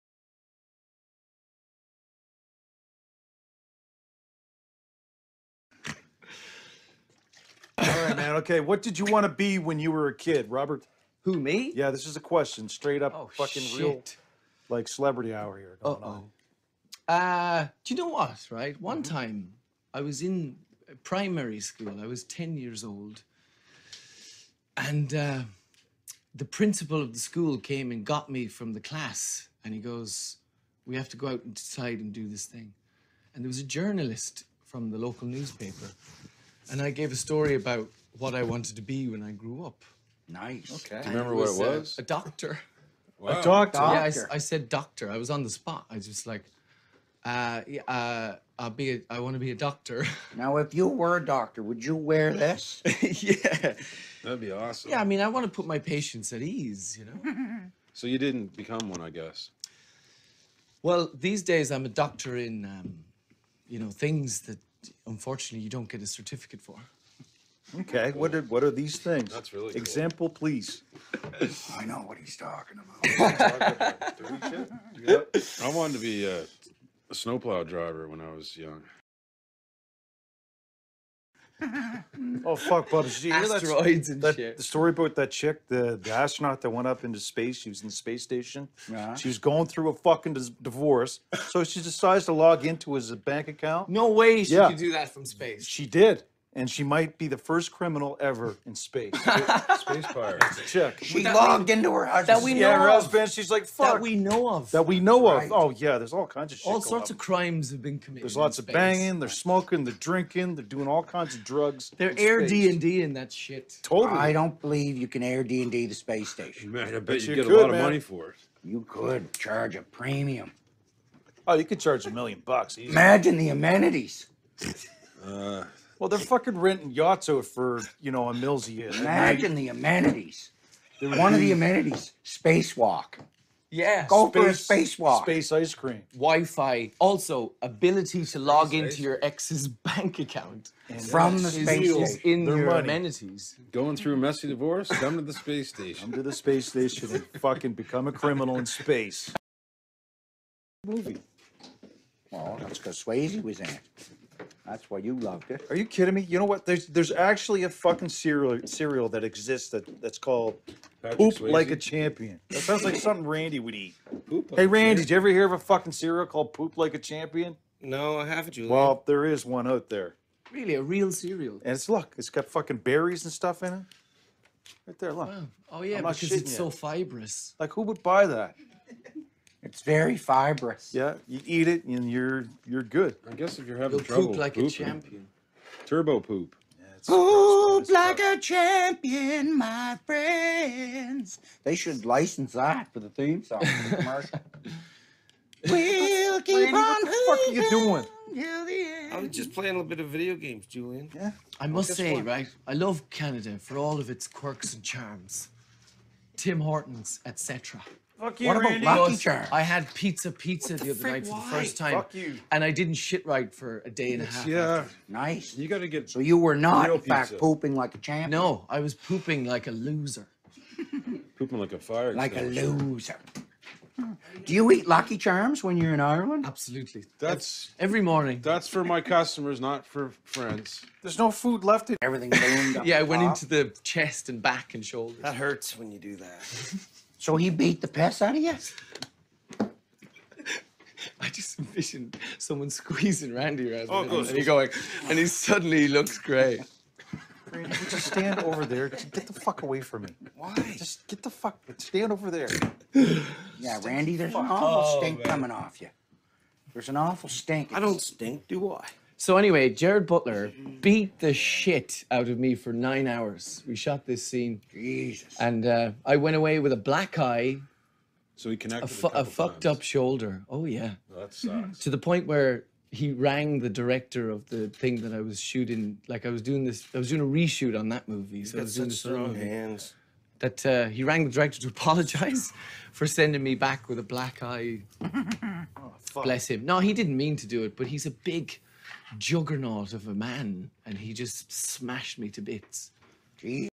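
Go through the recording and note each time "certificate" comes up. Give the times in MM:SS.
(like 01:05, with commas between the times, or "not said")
01:06.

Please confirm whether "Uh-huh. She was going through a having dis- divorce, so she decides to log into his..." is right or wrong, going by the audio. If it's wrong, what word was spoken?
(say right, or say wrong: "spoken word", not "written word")
wrong: "fucking", not "having".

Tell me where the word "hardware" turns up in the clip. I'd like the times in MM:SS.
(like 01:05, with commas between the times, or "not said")
not said.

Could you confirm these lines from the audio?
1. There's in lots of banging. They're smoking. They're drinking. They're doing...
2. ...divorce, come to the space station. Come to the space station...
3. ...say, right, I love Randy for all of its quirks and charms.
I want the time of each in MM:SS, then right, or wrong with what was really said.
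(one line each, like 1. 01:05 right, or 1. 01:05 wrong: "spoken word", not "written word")
1. 01:48 right
2. 02:24 right
3. 03:21 wrong: "Canada", not "Randy".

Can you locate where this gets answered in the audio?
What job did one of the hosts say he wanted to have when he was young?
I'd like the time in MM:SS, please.
01:17.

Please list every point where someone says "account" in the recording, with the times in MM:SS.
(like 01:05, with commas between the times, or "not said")
01:33, 02:20.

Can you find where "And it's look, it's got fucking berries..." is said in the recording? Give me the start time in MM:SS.
02:51.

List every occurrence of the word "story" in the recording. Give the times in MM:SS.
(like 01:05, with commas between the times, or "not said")
00:37, 01:24.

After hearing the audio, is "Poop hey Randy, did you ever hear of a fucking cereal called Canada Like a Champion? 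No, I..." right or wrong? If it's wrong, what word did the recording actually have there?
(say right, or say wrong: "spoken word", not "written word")
wrong: "Poop", not "Canada".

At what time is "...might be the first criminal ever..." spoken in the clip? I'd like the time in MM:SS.
01:36.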